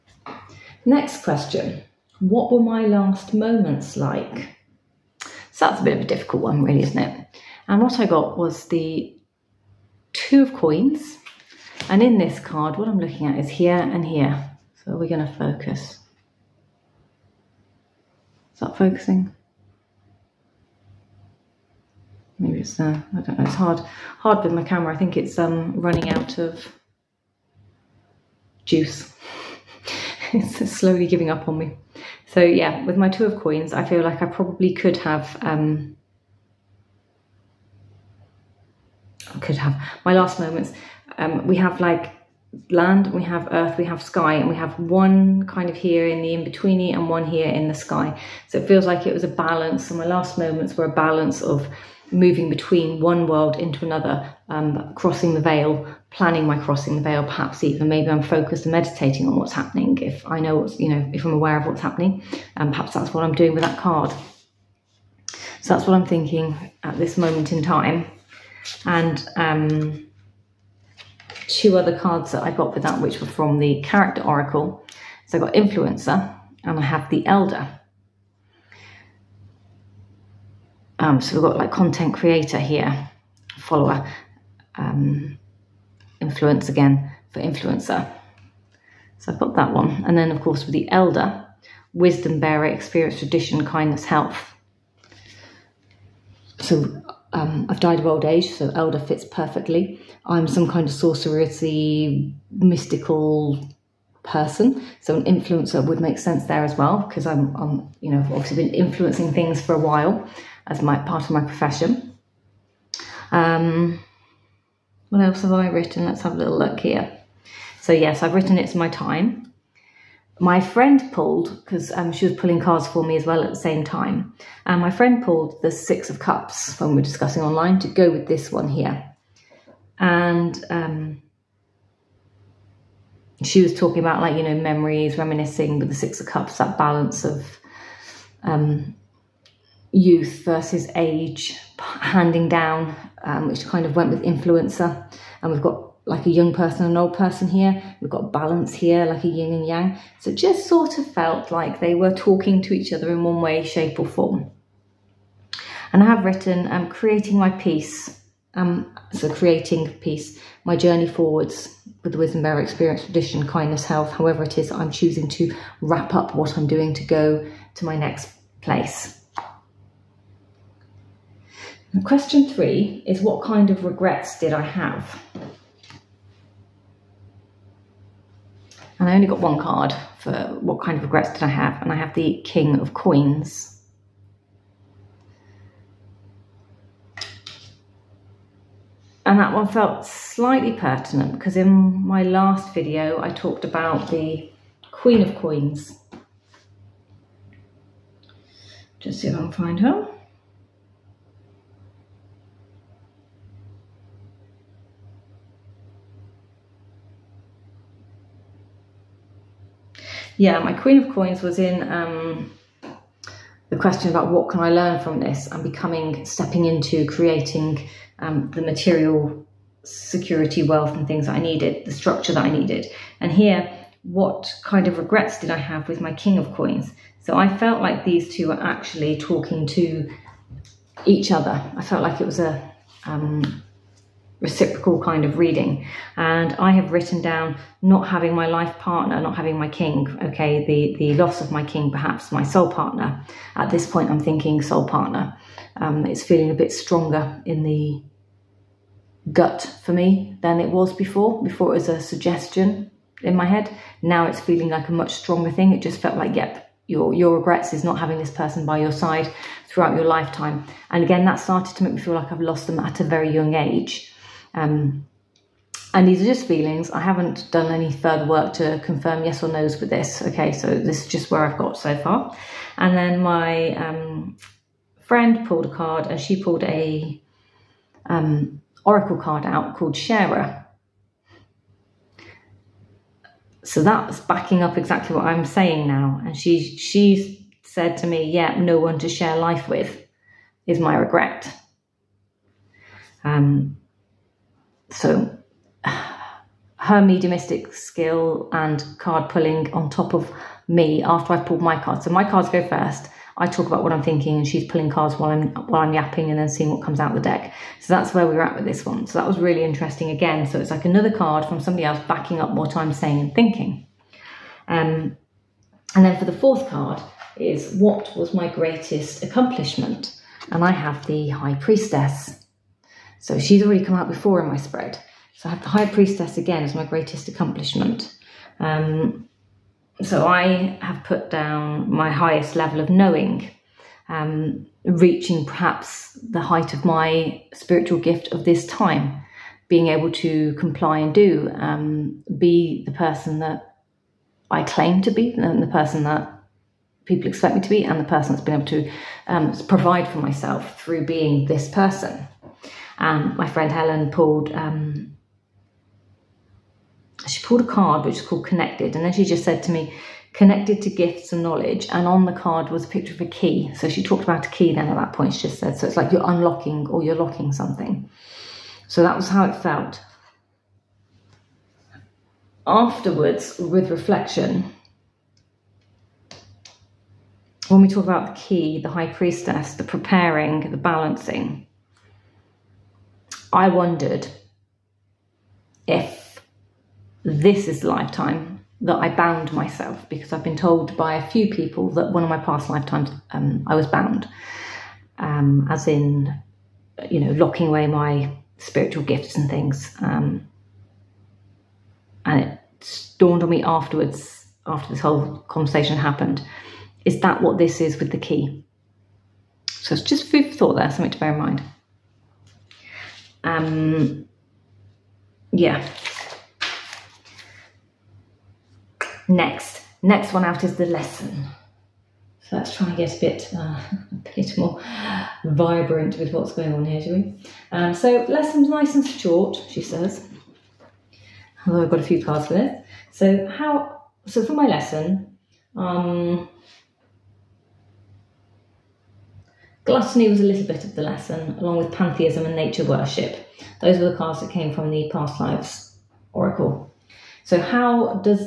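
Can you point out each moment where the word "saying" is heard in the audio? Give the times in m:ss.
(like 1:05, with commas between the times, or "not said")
4:45, 5:12.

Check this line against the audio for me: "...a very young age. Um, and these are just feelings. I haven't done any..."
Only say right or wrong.
right.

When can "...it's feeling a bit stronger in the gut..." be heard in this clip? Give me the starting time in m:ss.
4:06.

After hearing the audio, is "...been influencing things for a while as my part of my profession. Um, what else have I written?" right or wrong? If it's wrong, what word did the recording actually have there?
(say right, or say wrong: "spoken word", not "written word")
right.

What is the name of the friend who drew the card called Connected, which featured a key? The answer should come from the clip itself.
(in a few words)
Helen.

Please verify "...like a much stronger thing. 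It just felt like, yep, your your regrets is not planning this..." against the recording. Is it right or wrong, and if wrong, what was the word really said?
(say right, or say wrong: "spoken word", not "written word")
wrong: "having", not "planning".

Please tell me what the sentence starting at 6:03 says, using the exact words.
So she talked about a key then at that point, she just said, so it's like you're unlocking or you're locking something.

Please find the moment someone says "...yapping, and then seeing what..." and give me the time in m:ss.
5:05.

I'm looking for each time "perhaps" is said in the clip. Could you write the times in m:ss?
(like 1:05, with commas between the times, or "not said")
0:57, 1:02, 4:01, 5:35.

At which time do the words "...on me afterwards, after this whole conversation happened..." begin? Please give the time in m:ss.
6:43.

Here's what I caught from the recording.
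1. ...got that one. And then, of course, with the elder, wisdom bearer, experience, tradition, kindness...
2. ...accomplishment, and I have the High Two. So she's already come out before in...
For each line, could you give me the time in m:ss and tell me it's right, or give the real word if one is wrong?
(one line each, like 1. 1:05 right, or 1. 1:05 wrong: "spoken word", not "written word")
1. 1:29 right
2. 5:19 wrong: "Priestess", not "Two".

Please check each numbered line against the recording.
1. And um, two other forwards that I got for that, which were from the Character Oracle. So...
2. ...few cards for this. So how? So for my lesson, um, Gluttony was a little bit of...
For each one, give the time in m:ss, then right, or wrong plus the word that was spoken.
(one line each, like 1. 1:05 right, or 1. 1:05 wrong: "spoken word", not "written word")
1. 1:08 wrong: "cards", not "forwards"
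2. 7:12 right.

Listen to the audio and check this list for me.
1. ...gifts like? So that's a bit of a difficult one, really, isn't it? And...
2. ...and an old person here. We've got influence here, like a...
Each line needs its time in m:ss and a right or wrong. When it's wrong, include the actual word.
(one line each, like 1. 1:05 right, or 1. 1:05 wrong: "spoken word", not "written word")
1. 0:03 wrong: "moments", not "gifts"
2. 2:26 wrong: "balance", not "influence".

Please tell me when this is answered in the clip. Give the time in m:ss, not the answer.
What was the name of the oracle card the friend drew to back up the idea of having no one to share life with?
4:39.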